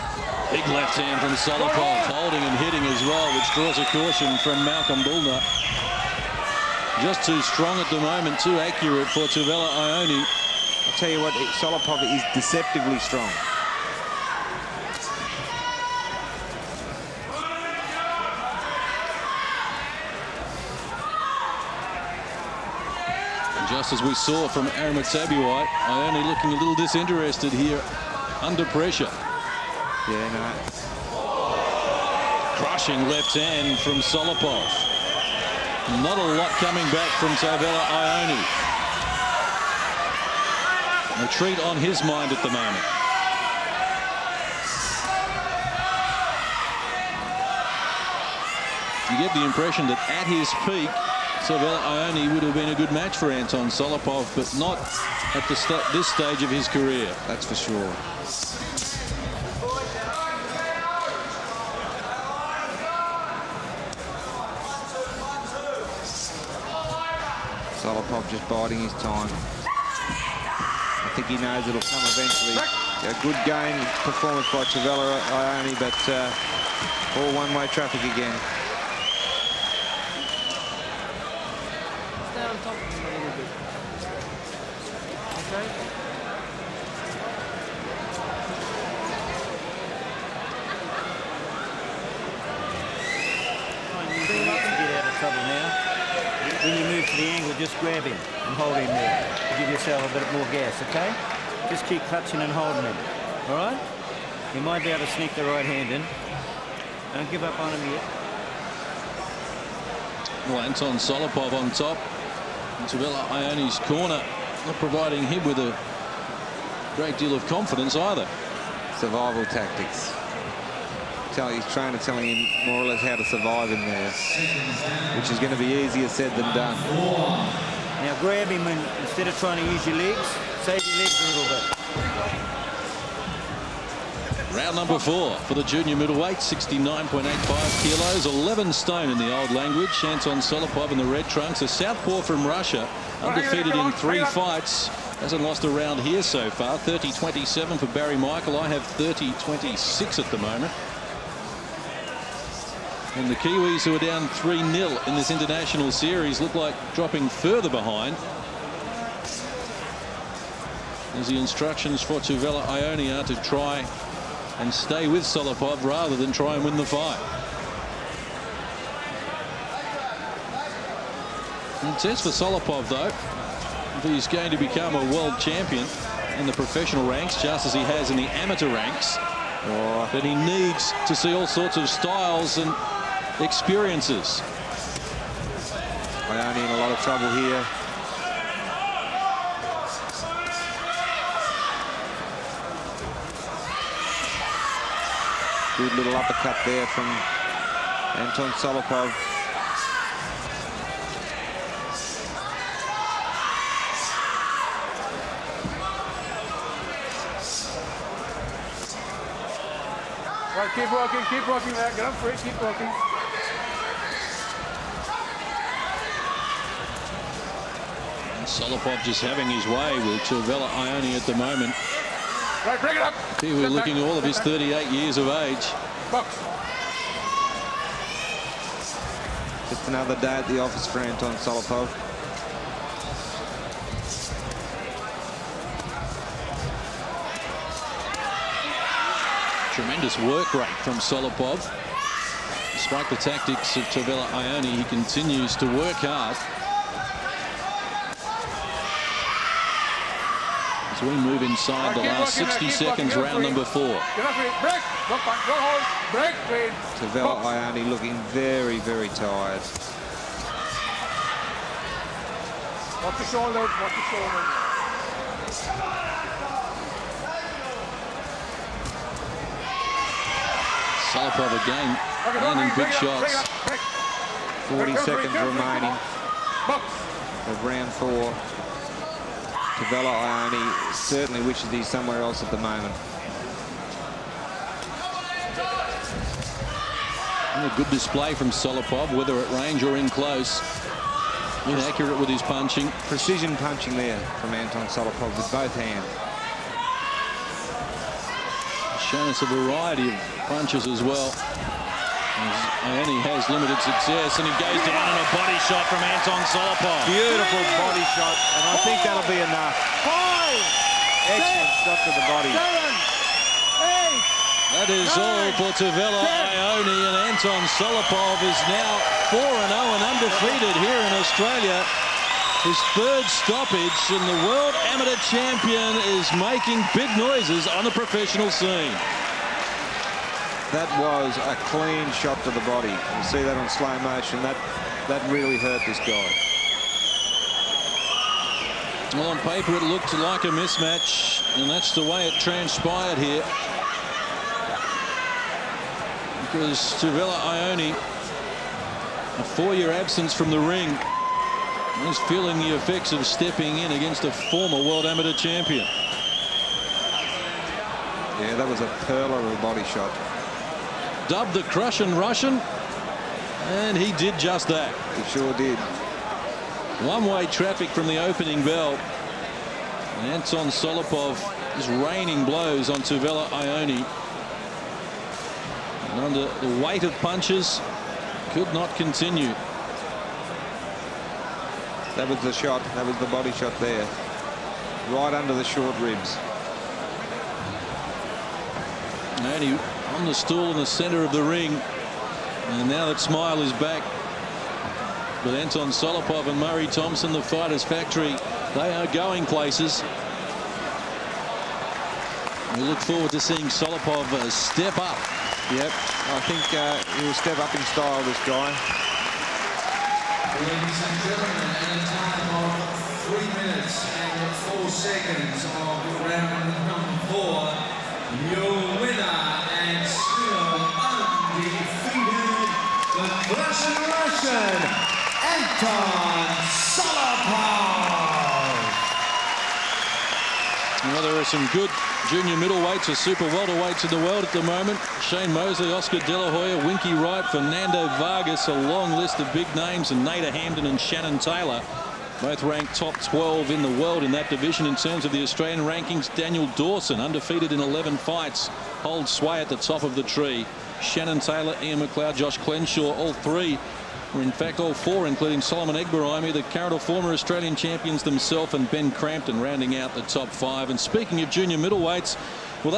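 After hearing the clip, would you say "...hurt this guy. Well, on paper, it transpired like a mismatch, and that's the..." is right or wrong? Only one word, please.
wrong.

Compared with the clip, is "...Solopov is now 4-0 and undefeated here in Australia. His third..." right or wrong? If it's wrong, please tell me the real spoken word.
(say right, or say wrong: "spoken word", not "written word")
right.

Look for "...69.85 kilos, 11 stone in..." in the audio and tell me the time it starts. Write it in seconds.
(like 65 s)
136 s.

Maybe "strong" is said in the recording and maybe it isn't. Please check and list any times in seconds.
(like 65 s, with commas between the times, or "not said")
7 s, 13 s.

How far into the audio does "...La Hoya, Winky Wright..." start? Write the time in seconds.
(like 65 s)
436 s.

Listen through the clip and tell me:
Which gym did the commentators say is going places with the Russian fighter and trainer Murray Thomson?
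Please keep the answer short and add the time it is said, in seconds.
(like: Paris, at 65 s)
the Fighters Factory, at 397 s.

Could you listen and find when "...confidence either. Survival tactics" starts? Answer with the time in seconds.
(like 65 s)
117 s.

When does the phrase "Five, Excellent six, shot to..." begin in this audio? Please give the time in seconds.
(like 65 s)
310 s.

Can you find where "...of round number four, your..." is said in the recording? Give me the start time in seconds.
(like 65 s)
415 s.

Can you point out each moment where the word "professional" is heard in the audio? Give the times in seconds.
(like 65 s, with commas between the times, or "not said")
176 s, 327 s.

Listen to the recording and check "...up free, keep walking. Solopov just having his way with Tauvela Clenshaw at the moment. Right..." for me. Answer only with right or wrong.
wrong.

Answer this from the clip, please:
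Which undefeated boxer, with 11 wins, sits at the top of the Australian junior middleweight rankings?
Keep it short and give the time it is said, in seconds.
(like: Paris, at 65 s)
Daniel Dawson, at 446 s.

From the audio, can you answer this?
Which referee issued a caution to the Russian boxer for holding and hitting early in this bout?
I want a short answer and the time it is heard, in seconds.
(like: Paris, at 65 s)
Malcolm Bulner, at 4 s.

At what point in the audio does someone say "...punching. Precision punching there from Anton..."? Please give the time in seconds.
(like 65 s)
292 s.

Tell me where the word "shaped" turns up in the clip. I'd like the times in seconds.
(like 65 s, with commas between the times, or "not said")
not said.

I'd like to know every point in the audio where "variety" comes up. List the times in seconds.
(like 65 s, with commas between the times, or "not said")
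299 s.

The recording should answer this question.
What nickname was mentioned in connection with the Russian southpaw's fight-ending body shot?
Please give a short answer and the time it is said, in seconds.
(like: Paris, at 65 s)
Crussian Russian, at 361 s.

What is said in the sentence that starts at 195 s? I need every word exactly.
Good little uppercut there from Anton Solopov.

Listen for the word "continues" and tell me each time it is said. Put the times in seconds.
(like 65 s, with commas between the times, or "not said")
244 s, 378 s.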